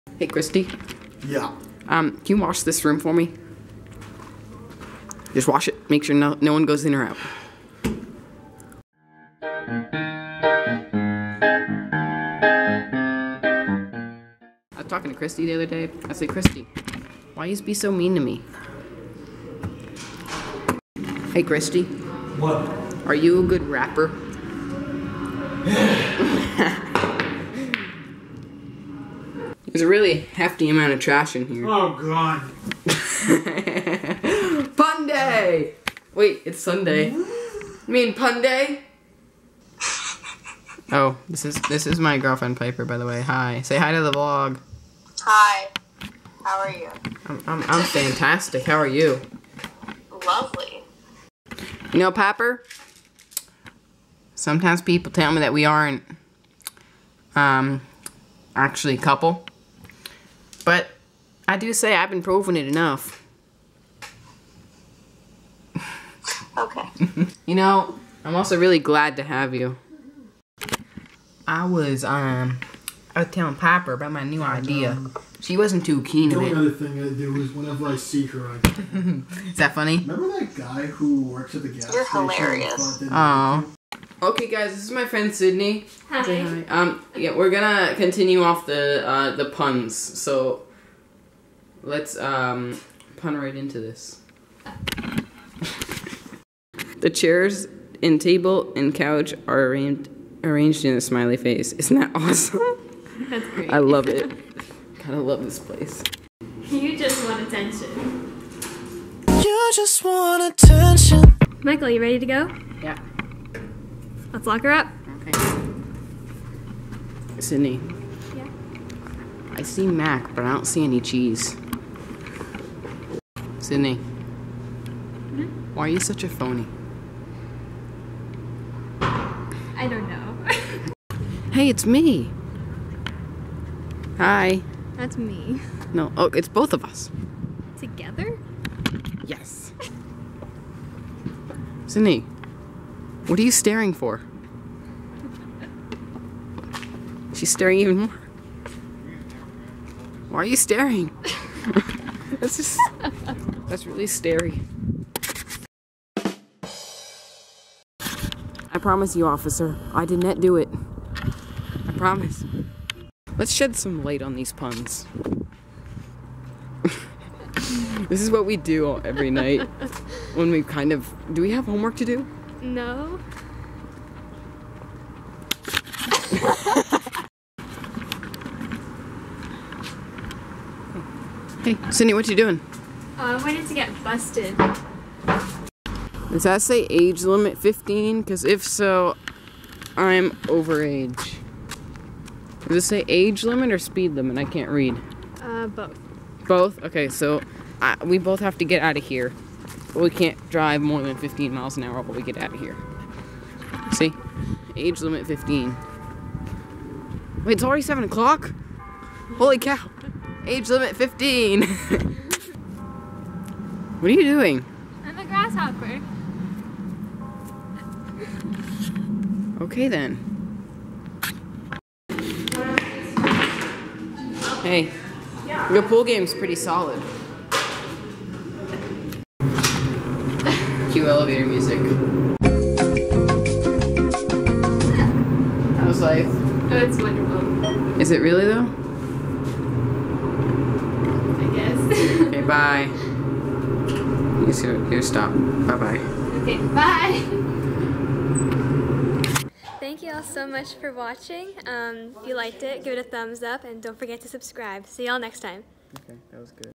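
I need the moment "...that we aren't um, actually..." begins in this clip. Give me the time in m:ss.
0:55.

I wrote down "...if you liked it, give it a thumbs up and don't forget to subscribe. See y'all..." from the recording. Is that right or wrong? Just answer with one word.
right.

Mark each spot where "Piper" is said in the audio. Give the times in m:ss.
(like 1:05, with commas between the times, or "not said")
0:42, 0:52, 1:13.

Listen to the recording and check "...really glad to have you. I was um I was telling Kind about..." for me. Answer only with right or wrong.
wrong.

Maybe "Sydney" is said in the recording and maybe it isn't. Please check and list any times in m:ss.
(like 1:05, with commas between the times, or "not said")
1:25, 1:57, 2:03, 2:21.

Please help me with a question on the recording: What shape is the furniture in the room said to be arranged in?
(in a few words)
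A smiley face.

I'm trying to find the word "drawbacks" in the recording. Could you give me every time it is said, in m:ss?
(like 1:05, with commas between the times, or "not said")
not said.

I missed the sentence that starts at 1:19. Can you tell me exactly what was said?
Remember that guy who works at the gas You're station?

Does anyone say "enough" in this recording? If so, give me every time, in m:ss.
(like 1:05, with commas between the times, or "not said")
1:02.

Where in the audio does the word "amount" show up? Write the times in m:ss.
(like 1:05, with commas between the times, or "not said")
0:30.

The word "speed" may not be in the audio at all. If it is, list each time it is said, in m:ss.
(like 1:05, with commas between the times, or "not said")
3:13.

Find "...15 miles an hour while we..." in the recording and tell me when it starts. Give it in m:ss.
3:21.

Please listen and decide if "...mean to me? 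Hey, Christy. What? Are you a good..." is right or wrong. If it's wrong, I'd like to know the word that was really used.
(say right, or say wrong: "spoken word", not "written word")
right.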